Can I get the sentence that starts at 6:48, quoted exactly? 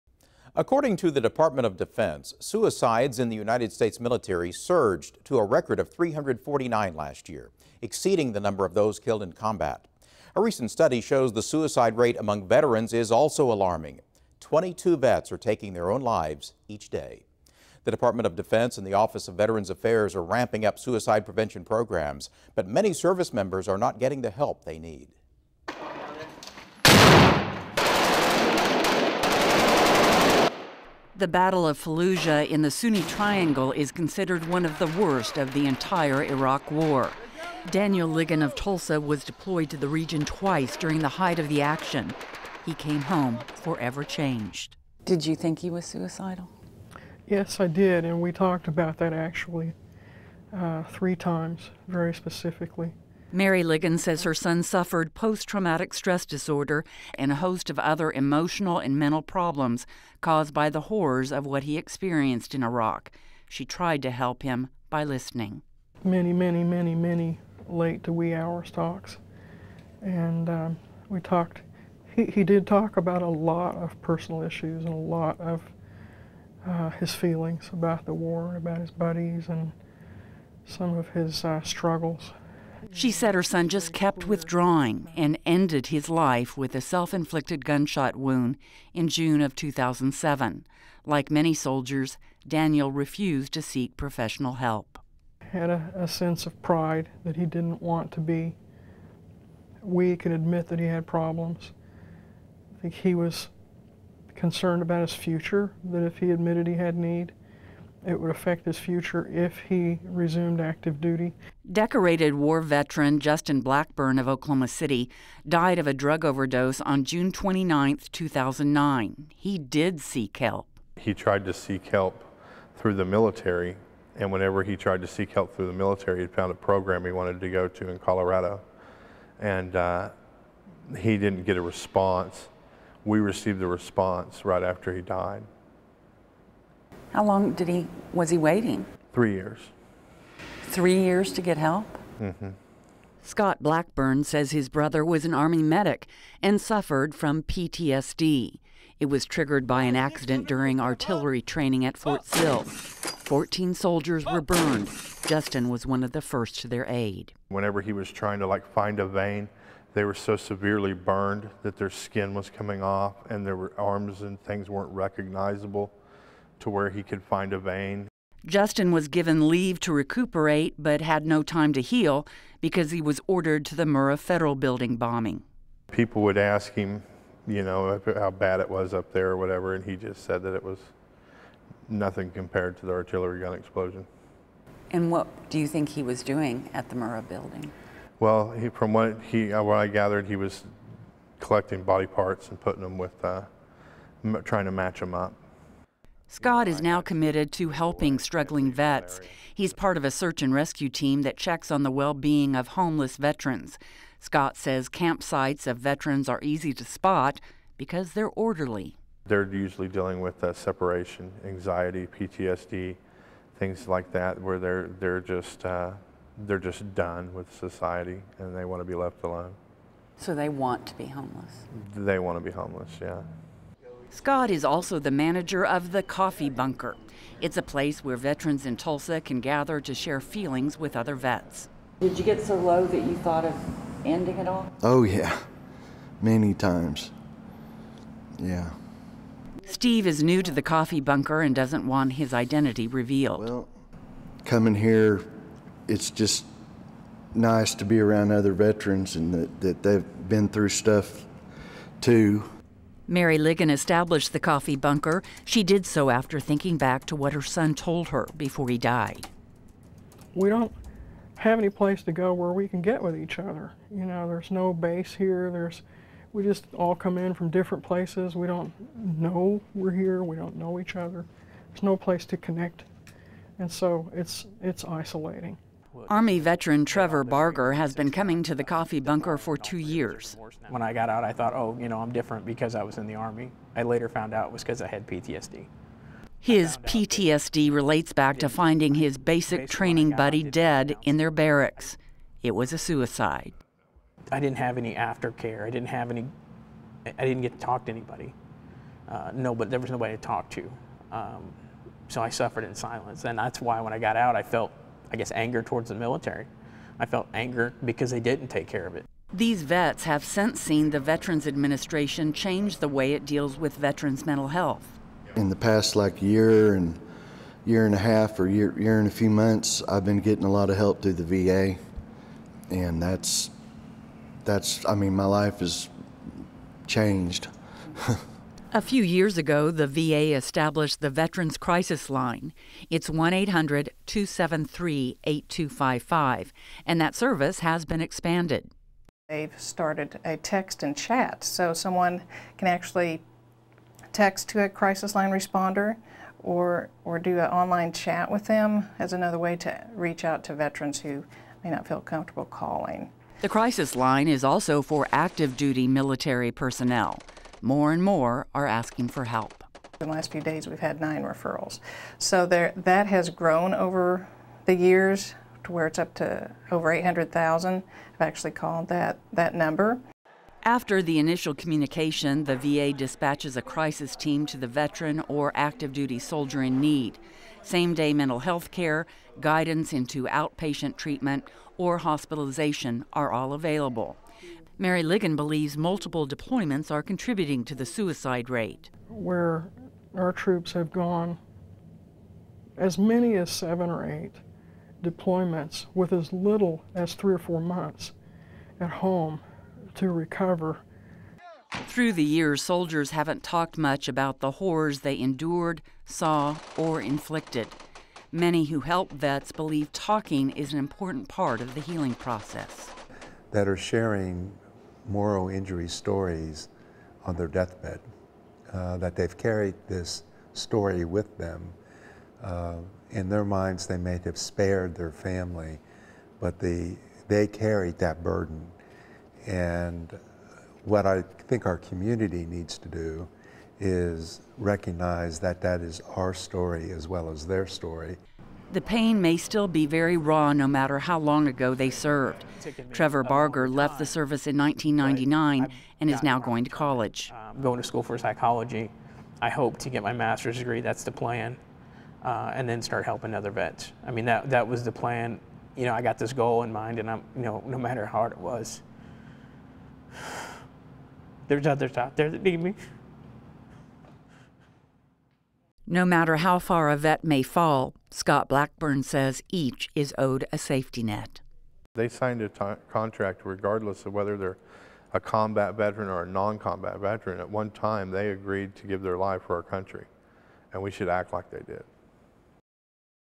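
Many who help vets believe talking is an important part of the healing process.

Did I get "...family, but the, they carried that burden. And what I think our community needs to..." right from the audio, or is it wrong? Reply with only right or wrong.
right.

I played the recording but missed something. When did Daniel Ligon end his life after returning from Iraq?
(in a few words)
June 2007.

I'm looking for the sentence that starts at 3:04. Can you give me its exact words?
And what do you think he was doing at the Murrah Building?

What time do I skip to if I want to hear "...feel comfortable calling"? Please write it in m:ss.
5:51.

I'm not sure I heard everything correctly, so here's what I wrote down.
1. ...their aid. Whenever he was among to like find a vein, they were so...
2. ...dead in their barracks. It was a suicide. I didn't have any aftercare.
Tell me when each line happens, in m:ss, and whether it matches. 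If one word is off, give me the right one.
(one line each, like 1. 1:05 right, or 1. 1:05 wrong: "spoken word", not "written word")
1. 2:36 wrong: "trying", not "among"
2. 4:50 right.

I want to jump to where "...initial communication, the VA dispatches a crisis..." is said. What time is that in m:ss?
6:11.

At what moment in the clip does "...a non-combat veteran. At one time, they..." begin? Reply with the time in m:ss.
7:56.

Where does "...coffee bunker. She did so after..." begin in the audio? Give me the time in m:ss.
4:14.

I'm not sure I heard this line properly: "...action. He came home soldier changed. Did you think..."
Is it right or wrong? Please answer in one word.
wrong.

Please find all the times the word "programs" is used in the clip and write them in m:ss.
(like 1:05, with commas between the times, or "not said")
0:21, 2:06.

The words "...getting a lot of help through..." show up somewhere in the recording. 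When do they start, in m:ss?
5:20.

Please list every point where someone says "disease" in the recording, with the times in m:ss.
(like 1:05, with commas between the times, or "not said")
not said.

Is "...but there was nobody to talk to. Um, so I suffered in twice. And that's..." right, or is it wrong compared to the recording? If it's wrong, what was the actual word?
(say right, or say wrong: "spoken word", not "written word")
wrong: "silence", not "twice".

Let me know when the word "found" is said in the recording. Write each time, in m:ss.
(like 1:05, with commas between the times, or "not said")
2:06, 4:44.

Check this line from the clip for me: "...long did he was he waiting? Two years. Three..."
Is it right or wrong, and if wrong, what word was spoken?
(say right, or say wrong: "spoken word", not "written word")
wrong: "Three", not "Two".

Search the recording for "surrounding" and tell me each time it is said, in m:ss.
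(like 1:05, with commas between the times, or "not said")
not said.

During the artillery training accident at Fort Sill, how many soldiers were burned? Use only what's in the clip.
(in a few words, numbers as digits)
14.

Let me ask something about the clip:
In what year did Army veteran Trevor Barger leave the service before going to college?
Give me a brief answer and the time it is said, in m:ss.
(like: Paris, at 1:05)
1999, at 7:24.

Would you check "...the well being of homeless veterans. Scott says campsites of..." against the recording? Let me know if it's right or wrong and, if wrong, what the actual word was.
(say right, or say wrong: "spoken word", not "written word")
right.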